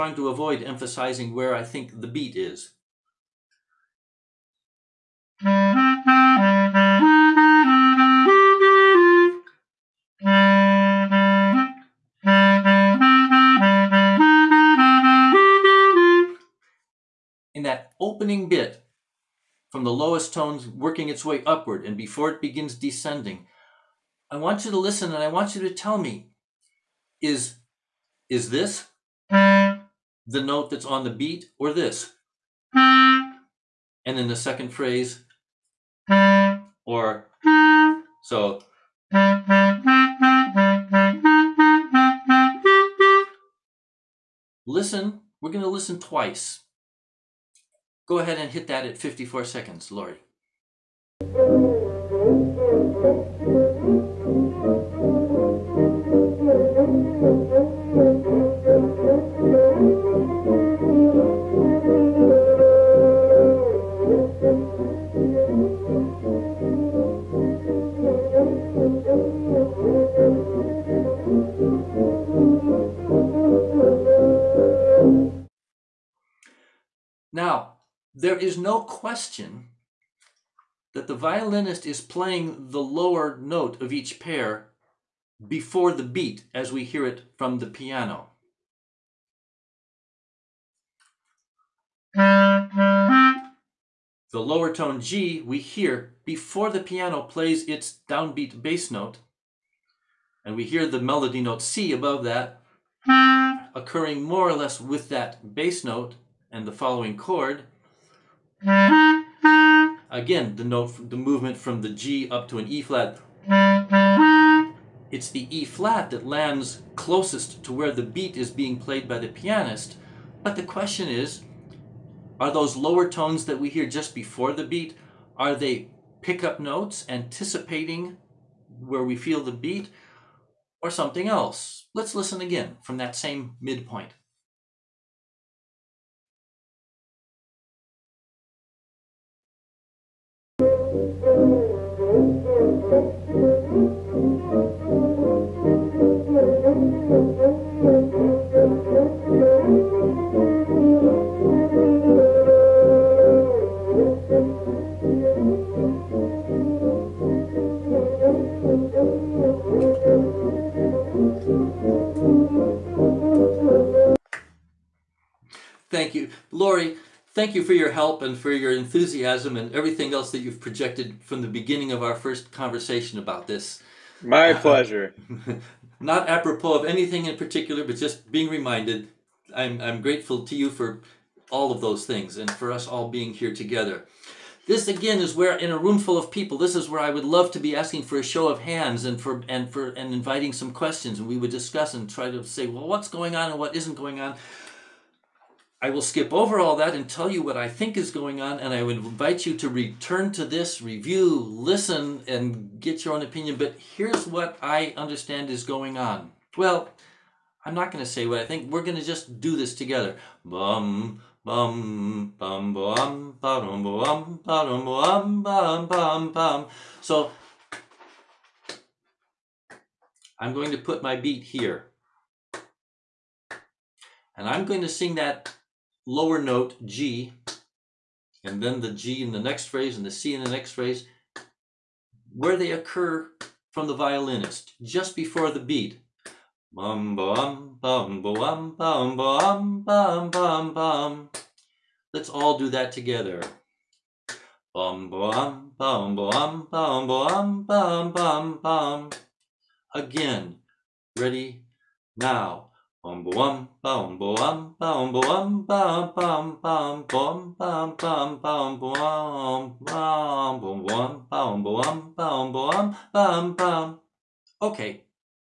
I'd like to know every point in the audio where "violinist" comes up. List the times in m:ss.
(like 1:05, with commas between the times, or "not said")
1:21, 3:53.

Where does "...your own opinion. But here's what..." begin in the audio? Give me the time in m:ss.
3:23.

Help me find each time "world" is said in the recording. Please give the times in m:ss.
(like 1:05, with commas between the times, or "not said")
not said.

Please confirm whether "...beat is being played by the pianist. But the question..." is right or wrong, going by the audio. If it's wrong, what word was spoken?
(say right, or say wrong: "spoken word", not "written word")
right.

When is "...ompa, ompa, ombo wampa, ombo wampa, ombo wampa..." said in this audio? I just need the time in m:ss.
4:18.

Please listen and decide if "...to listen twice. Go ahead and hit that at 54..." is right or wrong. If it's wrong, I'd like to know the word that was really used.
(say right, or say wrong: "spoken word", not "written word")
right.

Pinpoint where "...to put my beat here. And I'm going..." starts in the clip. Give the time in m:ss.
3:40.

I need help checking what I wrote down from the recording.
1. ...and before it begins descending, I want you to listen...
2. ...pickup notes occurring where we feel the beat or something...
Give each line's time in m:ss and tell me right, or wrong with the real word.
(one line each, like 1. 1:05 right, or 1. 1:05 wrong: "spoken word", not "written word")
1. 0:21 right
2. 2:06 wrong: "anticipating", not "occurring".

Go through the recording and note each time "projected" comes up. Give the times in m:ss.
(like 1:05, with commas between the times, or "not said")
2:50.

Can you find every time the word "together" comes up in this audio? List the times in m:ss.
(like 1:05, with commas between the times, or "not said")
3:03, 3:29, 4:02.